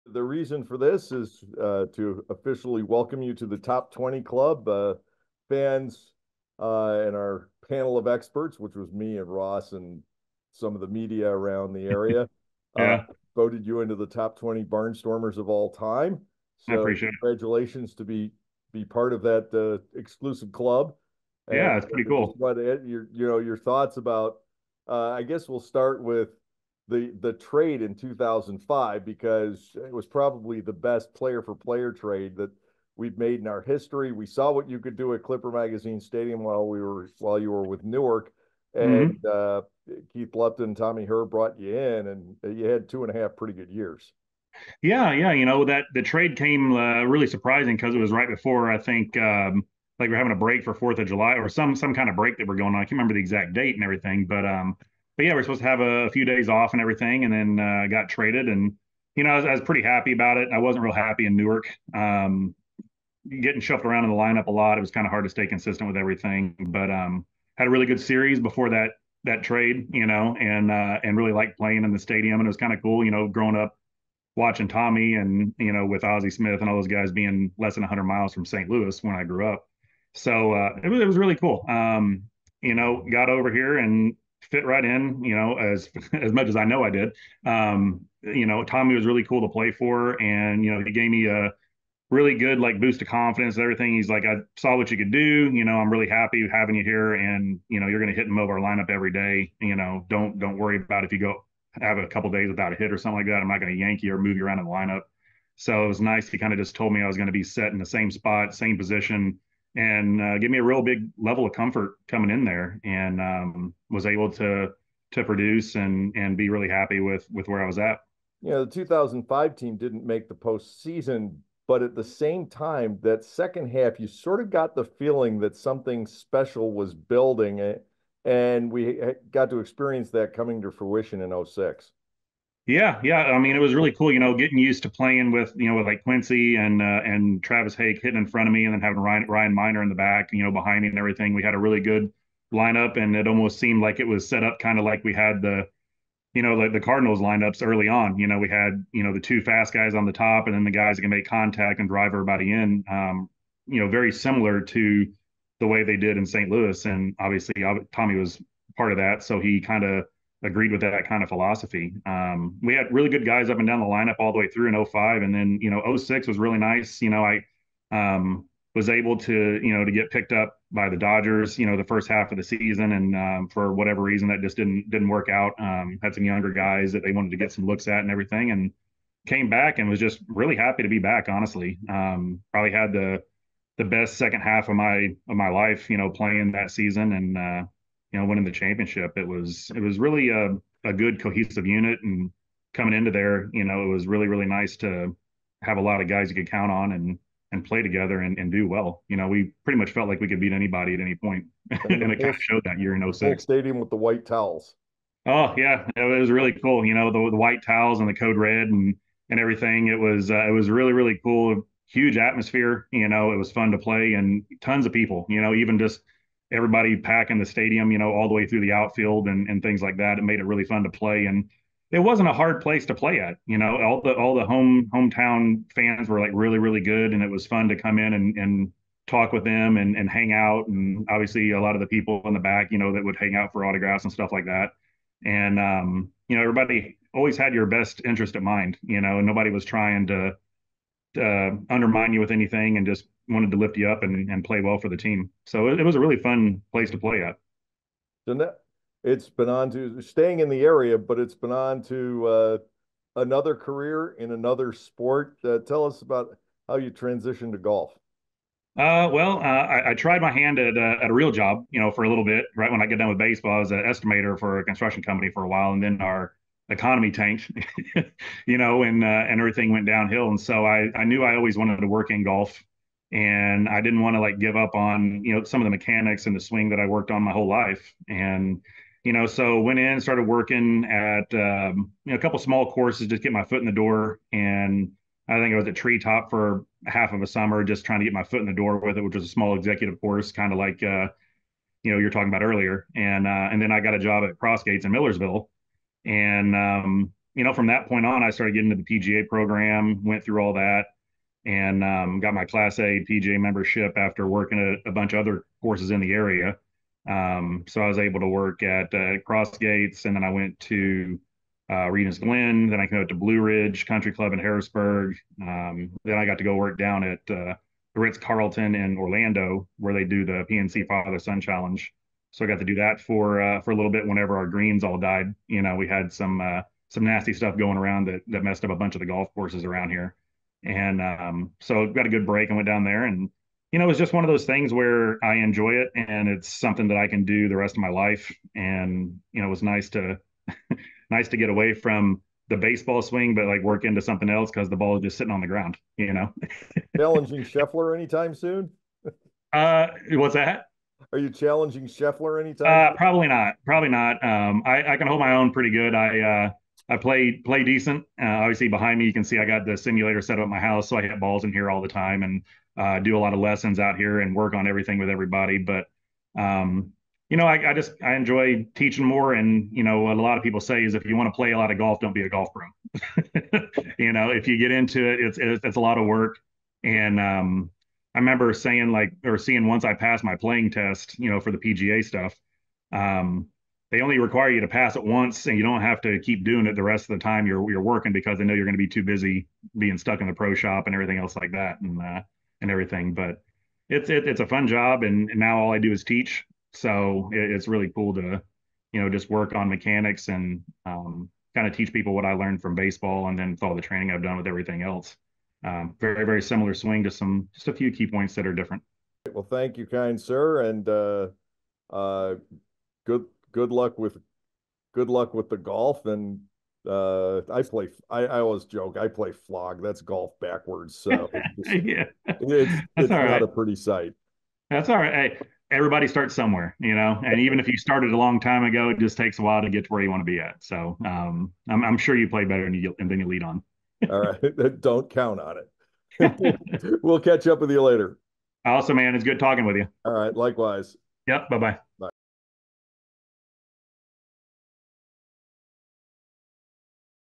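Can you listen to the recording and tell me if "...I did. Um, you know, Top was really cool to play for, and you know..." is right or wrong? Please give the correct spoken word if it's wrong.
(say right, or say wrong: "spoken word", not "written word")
wrong: "Tommy", not "Top".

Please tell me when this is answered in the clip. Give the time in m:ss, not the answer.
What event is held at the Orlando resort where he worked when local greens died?
5:20.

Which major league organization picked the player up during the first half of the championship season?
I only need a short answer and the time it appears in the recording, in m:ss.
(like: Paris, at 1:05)
Dodgers, at 2:50.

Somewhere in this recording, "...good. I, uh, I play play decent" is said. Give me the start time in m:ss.
5:55.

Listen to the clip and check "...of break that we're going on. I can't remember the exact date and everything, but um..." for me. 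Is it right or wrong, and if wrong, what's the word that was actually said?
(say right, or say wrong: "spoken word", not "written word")
right.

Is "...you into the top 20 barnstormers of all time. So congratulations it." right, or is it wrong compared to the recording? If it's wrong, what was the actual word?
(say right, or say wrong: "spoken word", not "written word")
right.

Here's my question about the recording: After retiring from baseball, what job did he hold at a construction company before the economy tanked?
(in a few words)
Estimator.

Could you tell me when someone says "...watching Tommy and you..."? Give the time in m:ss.
1:14.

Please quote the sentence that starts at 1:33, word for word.
He's like, I saw what you could do.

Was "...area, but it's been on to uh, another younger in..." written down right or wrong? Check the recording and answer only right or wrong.
wrong.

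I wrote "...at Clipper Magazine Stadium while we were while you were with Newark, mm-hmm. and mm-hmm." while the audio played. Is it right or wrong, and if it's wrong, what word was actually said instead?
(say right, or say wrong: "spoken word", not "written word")
right.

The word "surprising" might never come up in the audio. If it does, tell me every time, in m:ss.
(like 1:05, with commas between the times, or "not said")
0:47.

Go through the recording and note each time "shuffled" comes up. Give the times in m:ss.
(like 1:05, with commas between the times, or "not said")
1:03.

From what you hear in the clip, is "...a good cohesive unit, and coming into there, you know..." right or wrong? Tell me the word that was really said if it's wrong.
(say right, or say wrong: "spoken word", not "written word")
right.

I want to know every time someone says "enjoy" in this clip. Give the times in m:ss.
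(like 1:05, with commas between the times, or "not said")
5:35, 6:08.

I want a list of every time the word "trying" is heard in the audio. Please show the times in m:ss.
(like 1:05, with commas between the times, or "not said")
3:59, 4:47.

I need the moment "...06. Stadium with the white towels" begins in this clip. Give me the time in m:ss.
3:23.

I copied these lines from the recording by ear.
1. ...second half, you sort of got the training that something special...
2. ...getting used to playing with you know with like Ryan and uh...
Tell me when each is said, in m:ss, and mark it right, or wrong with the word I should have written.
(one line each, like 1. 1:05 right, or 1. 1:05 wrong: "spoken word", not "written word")
1. 2:03 wrong: "feeling", not "training"
2. 2:14 wrong: "Quincy", not "Ryan".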